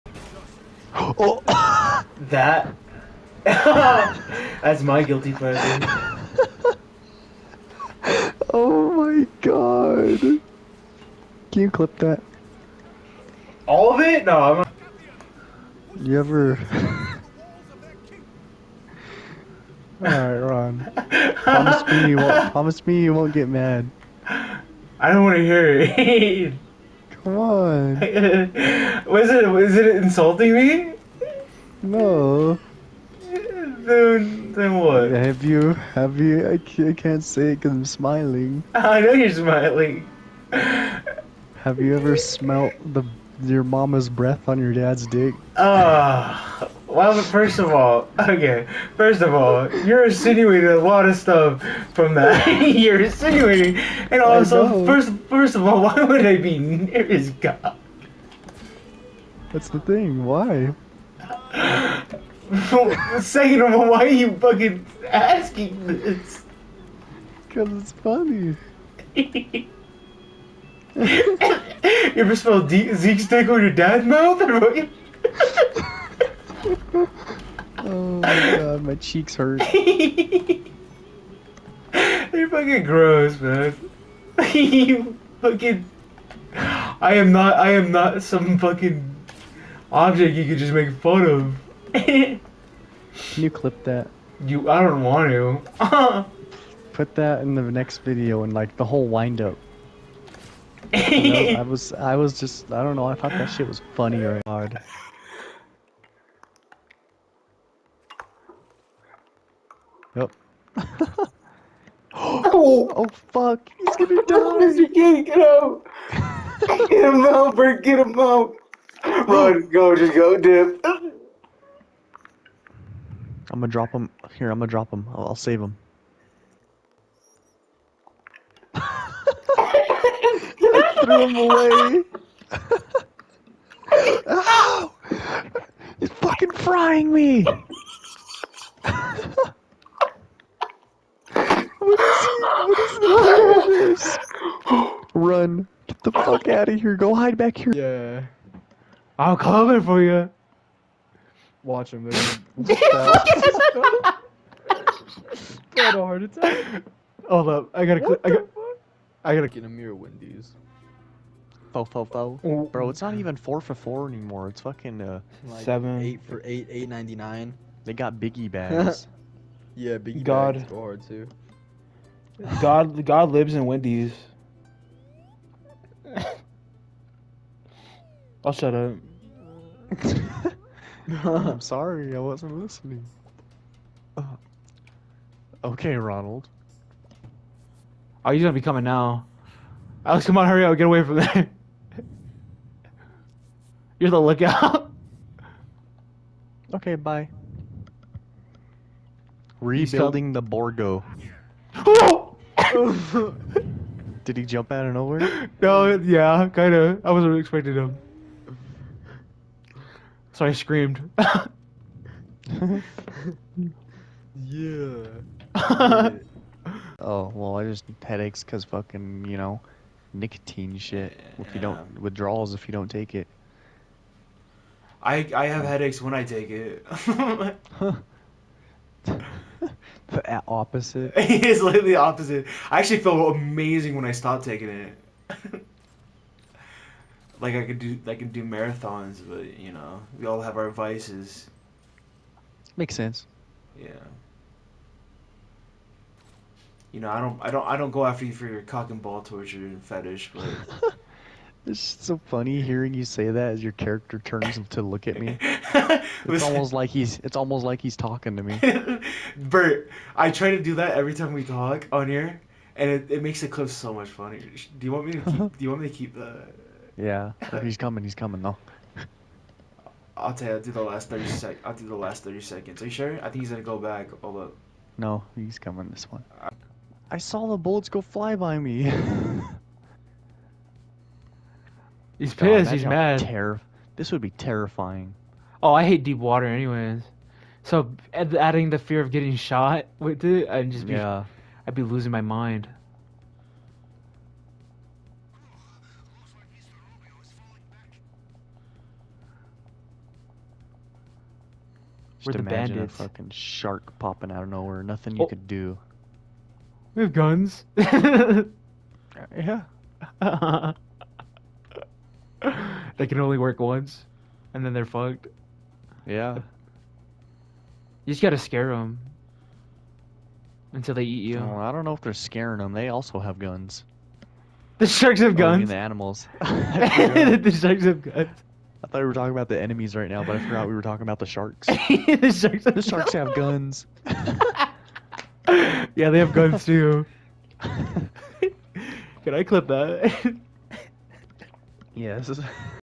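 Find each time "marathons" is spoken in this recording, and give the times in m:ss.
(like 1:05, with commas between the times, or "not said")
3:58.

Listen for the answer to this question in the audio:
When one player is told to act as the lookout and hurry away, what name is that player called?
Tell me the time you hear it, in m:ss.
3:10.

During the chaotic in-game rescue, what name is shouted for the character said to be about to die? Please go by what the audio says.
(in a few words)
Mr. King.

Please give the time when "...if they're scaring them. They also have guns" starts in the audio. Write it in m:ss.
5:21.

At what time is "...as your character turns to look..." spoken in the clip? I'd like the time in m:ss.
4:13.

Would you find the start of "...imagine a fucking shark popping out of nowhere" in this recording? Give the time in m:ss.
5:02.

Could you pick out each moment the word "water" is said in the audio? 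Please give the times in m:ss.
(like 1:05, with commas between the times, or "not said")
4:46.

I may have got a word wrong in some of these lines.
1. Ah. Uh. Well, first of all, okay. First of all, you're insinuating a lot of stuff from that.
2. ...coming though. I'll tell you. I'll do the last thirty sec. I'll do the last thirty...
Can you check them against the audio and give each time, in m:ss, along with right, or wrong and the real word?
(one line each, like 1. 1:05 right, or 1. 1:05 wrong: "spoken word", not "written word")
1. 0:45 right
2. 4:28 right.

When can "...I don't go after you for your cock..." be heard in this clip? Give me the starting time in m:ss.
4:07.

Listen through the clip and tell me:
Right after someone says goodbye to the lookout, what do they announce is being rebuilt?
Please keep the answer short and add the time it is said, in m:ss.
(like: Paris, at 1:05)
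The Borgo, at 3:20.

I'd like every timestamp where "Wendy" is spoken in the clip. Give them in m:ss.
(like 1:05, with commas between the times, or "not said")
2:39, 2:53.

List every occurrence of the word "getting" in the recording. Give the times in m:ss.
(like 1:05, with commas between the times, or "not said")
4:49.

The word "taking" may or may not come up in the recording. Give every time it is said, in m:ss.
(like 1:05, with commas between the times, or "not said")
3:54.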